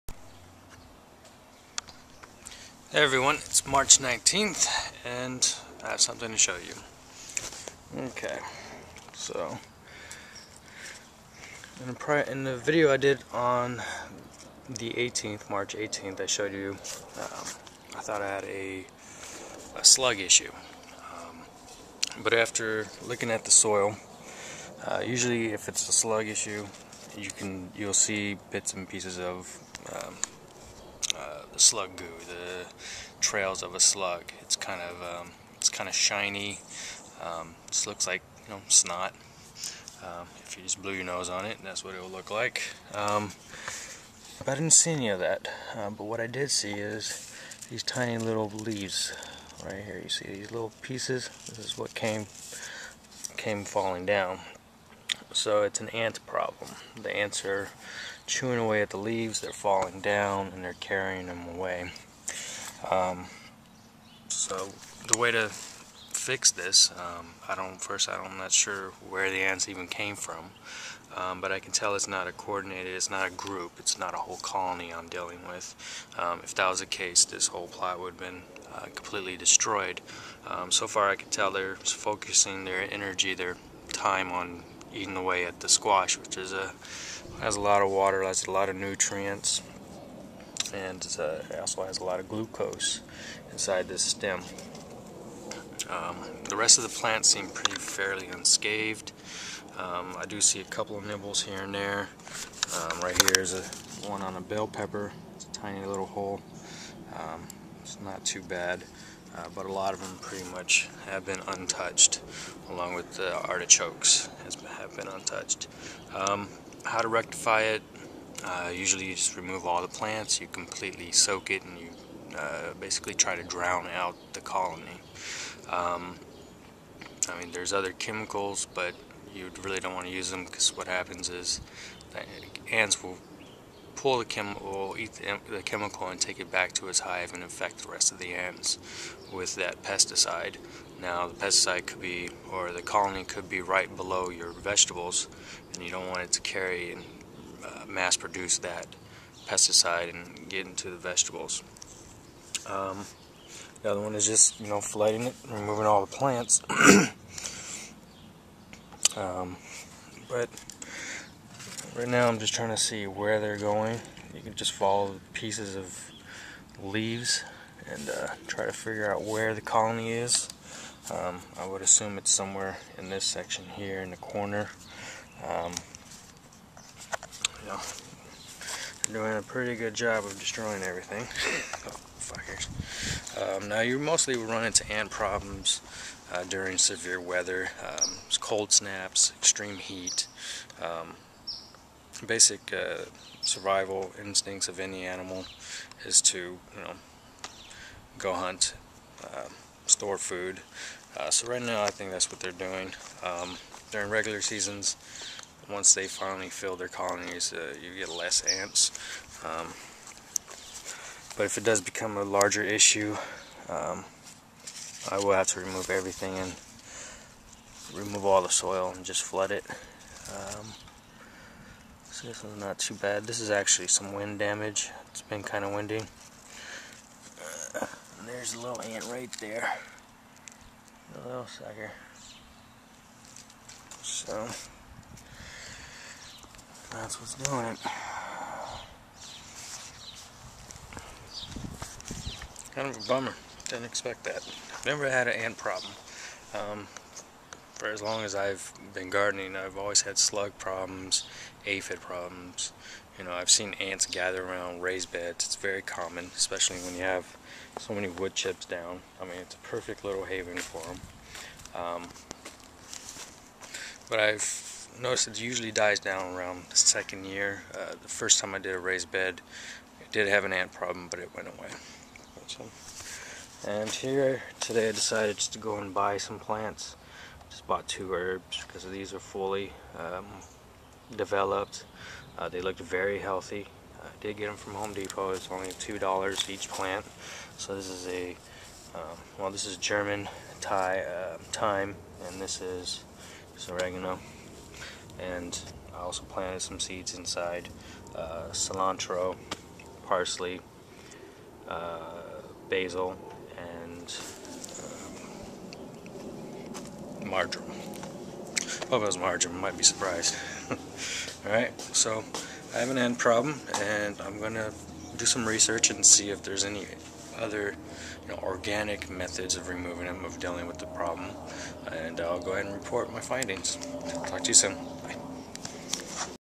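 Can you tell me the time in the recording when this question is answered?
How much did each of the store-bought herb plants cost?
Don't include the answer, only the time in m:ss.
4:45.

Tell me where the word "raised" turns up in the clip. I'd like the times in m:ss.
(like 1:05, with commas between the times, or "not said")
4:14, 4:28.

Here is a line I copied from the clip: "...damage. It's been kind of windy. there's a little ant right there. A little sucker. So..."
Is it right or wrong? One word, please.
right.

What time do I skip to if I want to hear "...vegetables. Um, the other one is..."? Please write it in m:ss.
2:30.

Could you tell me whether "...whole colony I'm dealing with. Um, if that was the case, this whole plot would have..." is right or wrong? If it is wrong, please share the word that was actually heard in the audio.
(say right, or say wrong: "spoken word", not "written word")
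right.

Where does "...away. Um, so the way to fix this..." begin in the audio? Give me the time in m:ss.
1:01.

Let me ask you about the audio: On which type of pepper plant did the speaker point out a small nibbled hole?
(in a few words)
Bell pepper.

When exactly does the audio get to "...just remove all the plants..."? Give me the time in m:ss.
1:59.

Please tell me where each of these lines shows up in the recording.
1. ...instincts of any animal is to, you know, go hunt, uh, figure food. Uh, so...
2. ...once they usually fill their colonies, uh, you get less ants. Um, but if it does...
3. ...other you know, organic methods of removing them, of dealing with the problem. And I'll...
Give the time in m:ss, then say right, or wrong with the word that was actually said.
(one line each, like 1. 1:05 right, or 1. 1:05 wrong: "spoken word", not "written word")
1. 3:14 wrong: "store", not "figure"
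2. 3:25 wrong: "finally", not "usually"
3. 5:17 right.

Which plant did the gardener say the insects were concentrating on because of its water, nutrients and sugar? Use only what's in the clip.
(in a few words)
Squash.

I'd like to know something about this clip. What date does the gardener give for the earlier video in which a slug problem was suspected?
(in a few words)
March 18th.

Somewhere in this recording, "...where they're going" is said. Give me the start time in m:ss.
2:43.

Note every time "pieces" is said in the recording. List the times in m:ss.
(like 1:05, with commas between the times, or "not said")
0:28, 0:50, 2:45.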